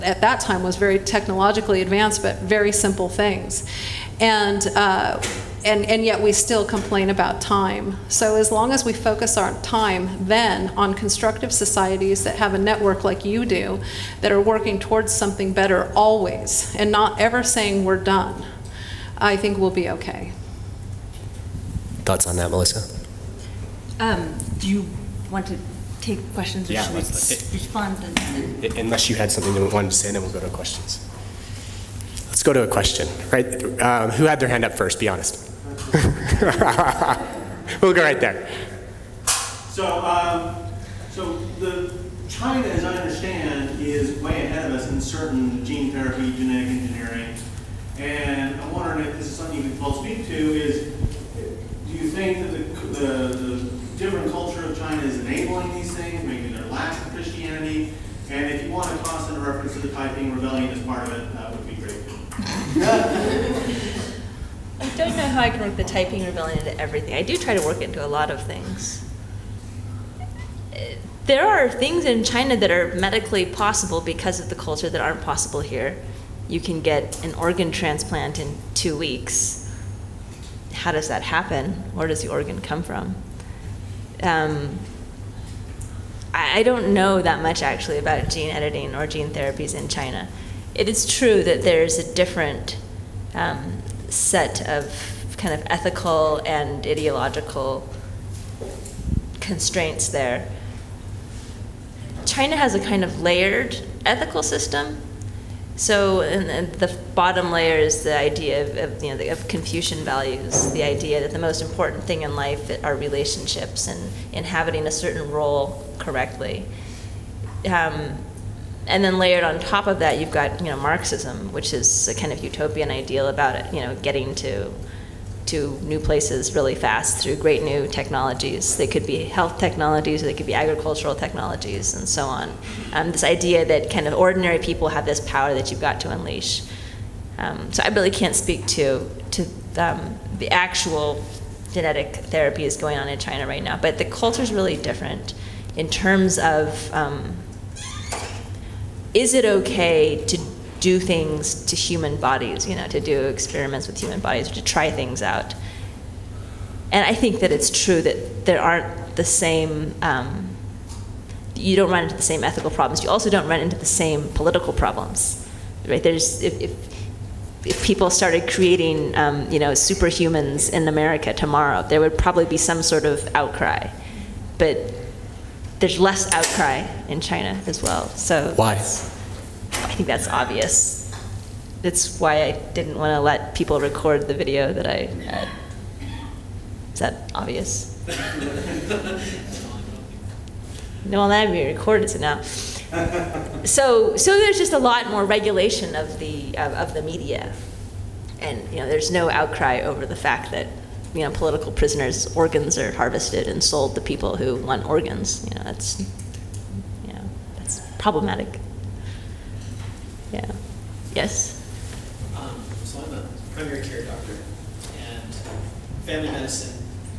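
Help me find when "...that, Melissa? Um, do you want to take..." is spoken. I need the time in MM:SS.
00:22.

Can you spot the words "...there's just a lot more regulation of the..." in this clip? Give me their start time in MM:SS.
03:14.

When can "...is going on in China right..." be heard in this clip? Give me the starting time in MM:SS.
02:22.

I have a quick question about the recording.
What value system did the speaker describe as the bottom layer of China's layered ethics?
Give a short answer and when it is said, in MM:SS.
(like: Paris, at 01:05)
Confucian values, at 01:49.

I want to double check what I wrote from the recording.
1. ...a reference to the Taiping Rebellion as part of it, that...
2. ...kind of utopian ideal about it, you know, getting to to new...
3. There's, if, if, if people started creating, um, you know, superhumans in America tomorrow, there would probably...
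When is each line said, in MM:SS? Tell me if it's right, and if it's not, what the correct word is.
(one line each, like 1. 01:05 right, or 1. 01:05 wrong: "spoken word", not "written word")
1. 00:59 right
2. 02:02 right
3. 02:46 right.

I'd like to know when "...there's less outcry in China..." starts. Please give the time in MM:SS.
02:55.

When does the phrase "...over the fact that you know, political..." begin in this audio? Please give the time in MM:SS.
03:19.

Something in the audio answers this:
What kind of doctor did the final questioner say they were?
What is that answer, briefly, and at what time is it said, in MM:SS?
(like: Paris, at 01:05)
Primary care doctor, at 03:33.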